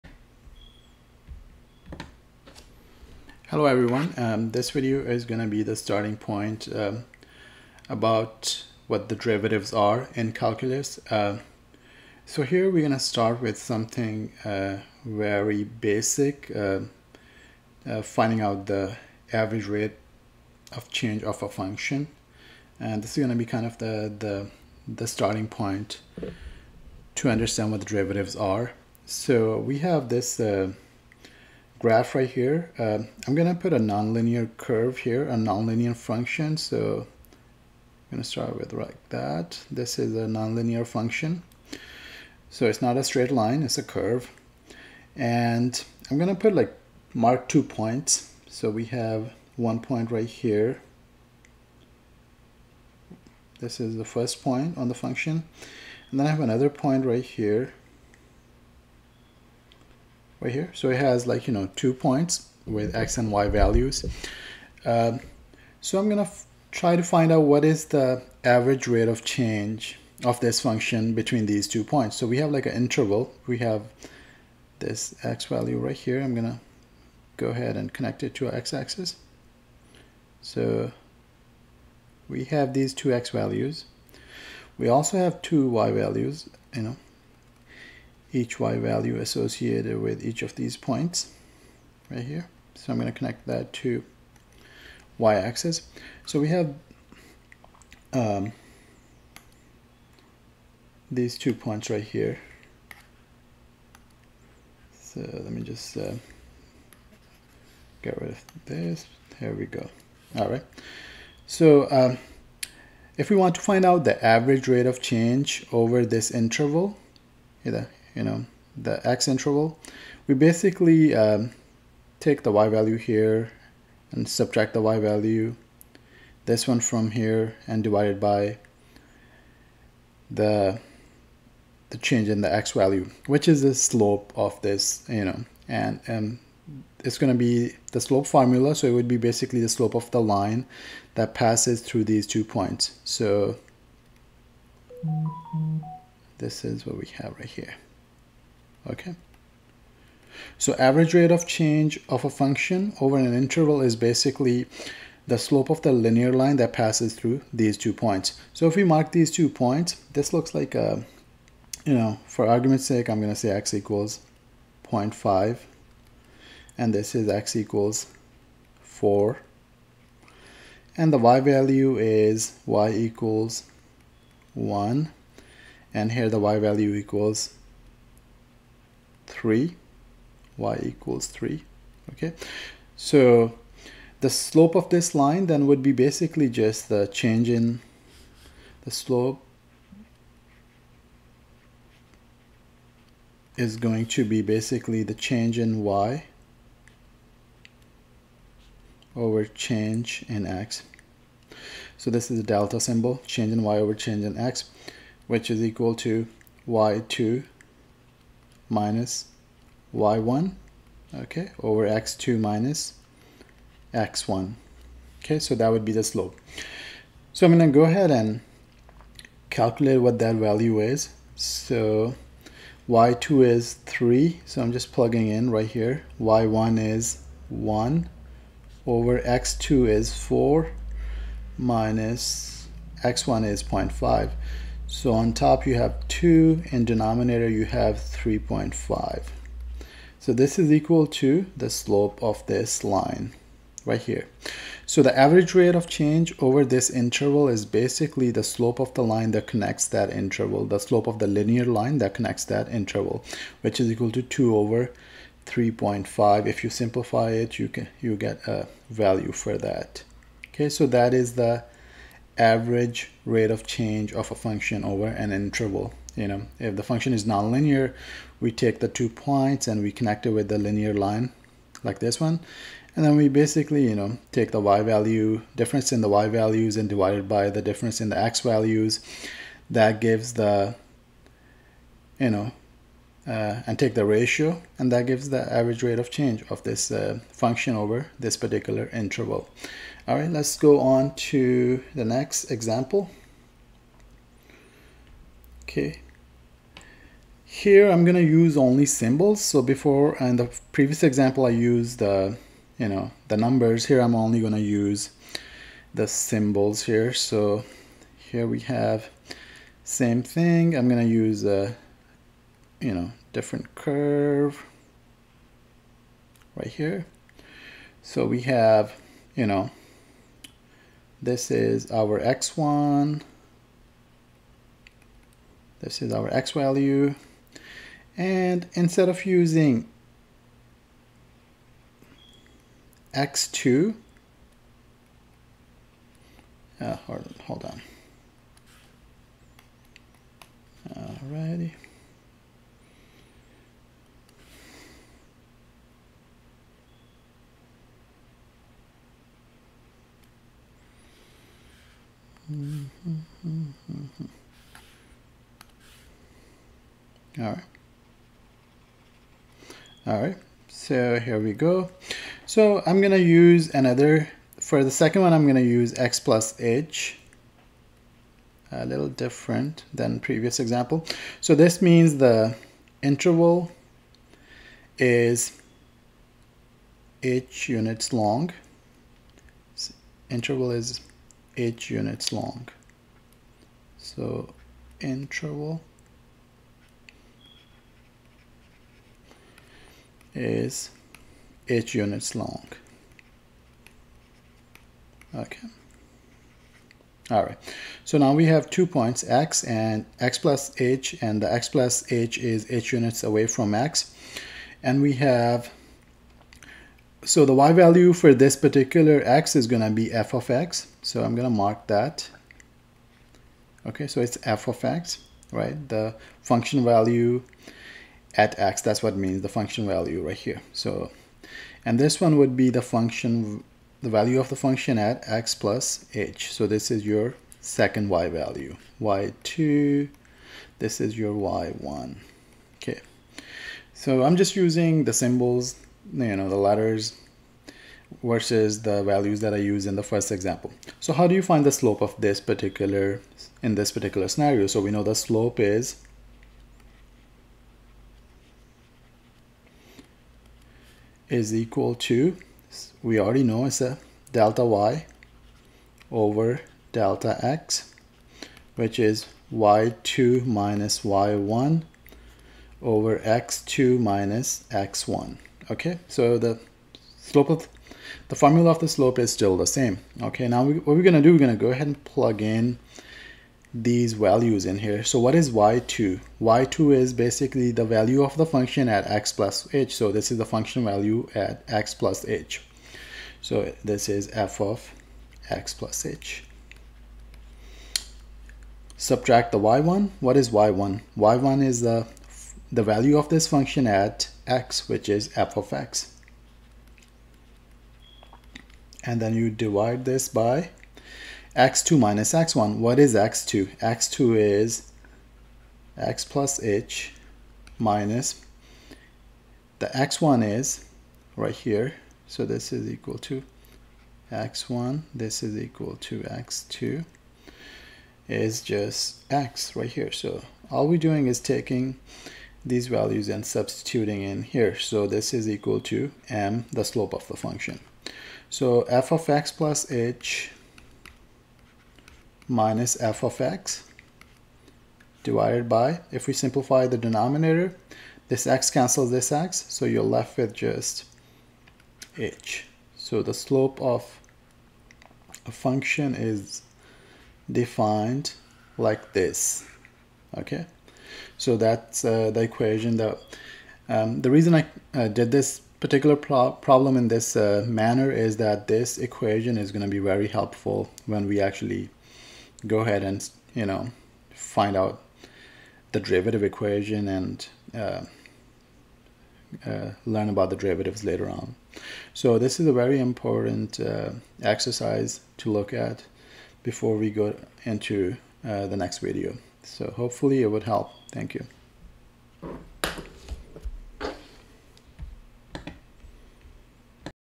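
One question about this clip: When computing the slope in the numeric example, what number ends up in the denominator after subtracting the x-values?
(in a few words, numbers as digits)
3.5.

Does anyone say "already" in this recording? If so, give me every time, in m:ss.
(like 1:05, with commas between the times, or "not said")
7:33.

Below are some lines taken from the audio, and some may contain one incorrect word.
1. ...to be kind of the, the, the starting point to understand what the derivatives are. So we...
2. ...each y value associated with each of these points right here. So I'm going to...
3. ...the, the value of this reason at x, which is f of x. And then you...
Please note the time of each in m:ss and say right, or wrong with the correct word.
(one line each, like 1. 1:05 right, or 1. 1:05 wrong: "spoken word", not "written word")
1. 0:23 right
2. 1:28 right
3. 8:11 wrong: "function", not "reason".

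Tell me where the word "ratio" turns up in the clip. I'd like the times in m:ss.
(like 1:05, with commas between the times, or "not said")
4:44.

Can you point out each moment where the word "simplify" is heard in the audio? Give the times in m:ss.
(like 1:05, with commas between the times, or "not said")
4:16, 8:56.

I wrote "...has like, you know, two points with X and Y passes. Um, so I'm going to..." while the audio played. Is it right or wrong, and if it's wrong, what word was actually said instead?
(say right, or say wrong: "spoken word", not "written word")
wrong: "values", not "passes".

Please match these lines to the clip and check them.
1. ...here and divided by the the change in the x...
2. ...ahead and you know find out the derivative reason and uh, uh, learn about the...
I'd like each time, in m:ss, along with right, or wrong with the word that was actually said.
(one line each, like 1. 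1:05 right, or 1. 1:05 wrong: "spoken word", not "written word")
1. 2:07 right
2. 9:22 wrong: "equation", not "reason".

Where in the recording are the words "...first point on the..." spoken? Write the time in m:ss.
0:54.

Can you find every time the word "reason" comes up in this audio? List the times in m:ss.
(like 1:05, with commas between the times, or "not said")
9:14.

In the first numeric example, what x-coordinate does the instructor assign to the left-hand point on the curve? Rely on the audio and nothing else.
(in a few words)
0.5.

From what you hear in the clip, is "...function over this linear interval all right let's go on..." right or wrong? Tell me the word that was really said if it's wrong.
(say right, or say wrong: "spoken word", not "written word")
wrong: "particular", not "linear".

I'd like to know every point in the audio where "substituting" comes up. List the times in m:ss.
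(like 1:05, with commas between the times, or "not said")
8:43.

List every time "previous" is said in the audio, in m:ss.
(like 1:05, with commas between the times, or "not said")
5:00, 6:10.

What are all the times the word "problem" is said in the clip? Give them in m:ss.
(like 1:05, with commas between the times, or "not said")
9:16.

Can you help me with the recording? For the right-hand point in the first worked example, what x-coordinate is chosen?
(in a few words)
4.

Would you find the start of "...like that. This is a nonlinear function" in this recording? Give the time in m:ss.
0:38.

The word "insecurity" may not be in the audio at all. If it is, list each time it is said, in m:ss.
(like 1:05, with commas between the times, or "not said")
not said.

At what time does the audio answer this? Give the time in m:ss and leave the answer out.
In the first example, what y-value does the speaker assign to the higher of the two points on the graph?
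3:00.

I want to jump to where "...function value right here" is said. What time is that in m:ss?
6:59.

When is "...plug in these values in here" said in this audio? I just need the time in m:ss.
7:52.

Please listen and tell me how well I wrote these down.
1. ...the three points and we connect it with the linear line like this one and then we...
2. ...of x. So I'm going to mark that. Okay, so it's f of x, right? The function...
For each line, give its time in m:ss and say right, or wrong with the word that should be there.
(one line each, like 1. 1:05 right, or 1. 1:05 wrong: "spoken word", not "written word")
1. 4:28 wrong: "two", not "three"
2. 6:50 right.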